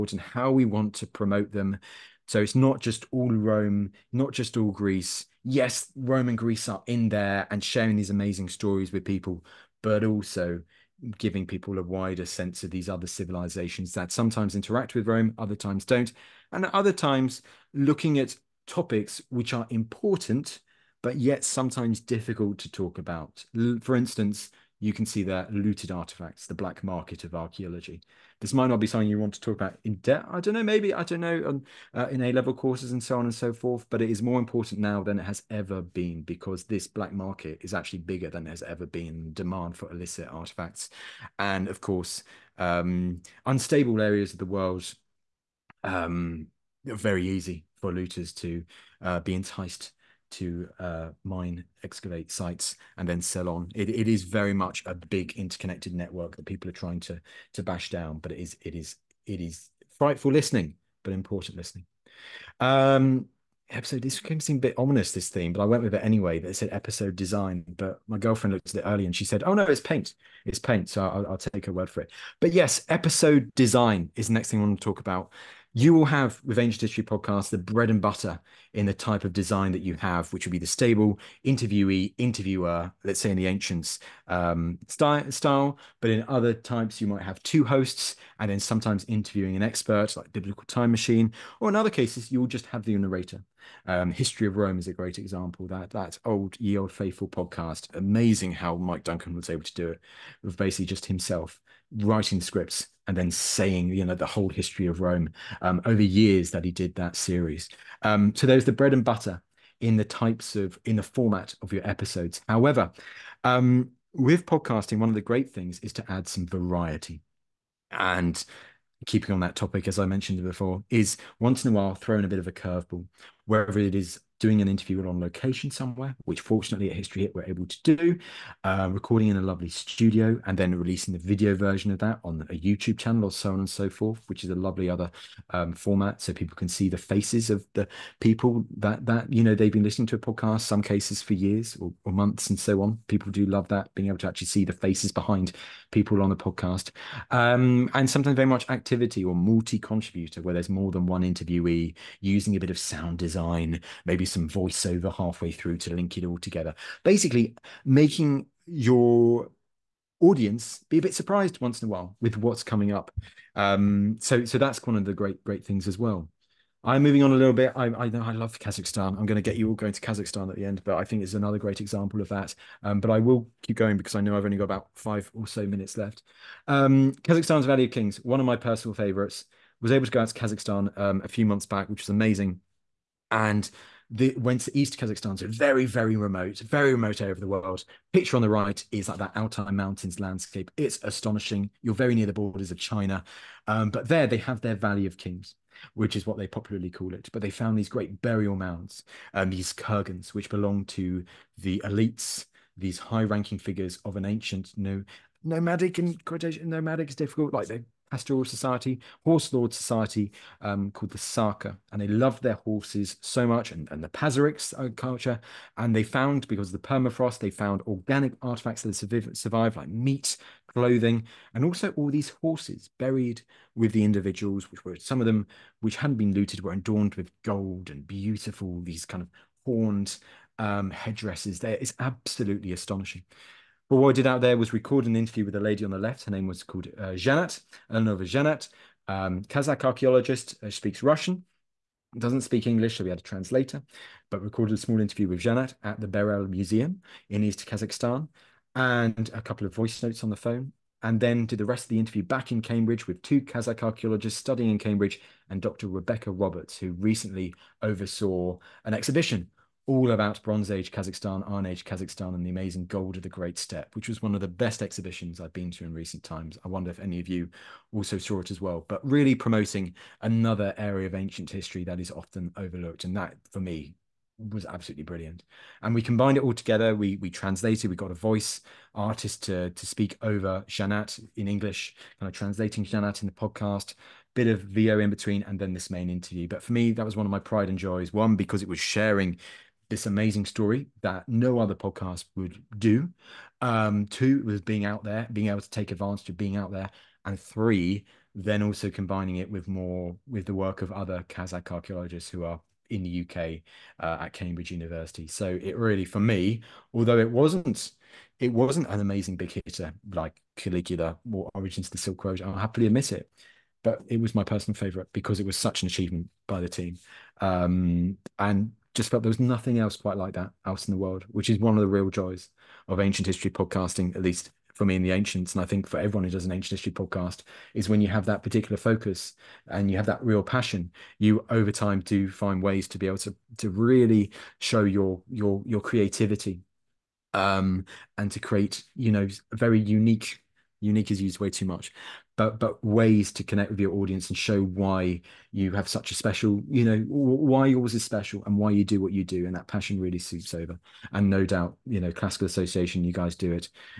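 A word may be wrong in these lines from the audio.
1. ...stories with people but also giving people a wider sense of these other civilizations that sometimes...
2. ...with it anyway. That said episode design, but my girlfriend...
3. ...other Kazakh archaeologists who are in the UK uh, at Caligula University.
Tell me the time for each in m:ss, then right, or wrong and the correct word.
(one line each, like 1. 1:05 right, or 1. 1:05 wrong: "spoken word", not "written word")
1. 0:08 right
2. 1:05 right
3. 5:00 wrong: "Cambridge", not "Caligula".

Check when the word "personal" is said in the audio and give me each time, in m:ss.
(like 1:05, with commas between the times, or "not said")
2:58, 5:14.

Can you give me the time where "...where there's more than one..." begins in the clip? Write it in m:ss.
2:30.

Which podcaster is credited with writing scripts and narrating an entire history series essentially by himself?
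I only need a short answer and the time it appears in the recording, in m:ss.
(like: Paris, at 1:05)
Mike Duncan, at 1:38.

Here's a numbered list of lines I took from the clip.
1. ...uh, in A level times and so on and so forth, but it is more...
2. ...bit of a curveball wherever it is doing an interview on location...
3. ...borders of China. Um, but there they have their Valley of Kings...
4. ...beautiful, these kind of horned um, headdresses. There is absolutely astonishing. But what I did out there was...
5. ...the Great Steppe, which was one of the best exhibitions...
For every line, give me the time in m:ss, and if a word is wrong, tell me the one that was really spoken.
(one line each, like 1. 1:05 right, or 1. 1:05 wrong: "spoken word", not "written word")
1. 0:31 wrong: "courses", not "times"
2. 2:02 right
3. 3:12 right
4. 3:48 right
5. 4:23 right.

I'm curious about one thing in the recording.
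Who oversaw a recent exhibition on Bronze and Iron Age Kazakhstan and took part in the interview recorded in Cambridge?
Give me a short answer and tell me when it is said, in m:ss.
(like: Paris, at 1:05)
Dr. Rebecca Roberts, at 4:15.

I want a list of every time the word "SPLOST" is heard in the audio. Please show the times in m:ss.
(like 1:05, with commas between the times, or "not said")
not said.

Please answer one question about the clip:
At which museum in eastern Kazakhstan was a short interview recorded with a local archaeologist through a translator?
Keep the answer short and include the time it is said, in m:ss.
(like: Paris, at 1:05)
Berel Museum, at 4:06.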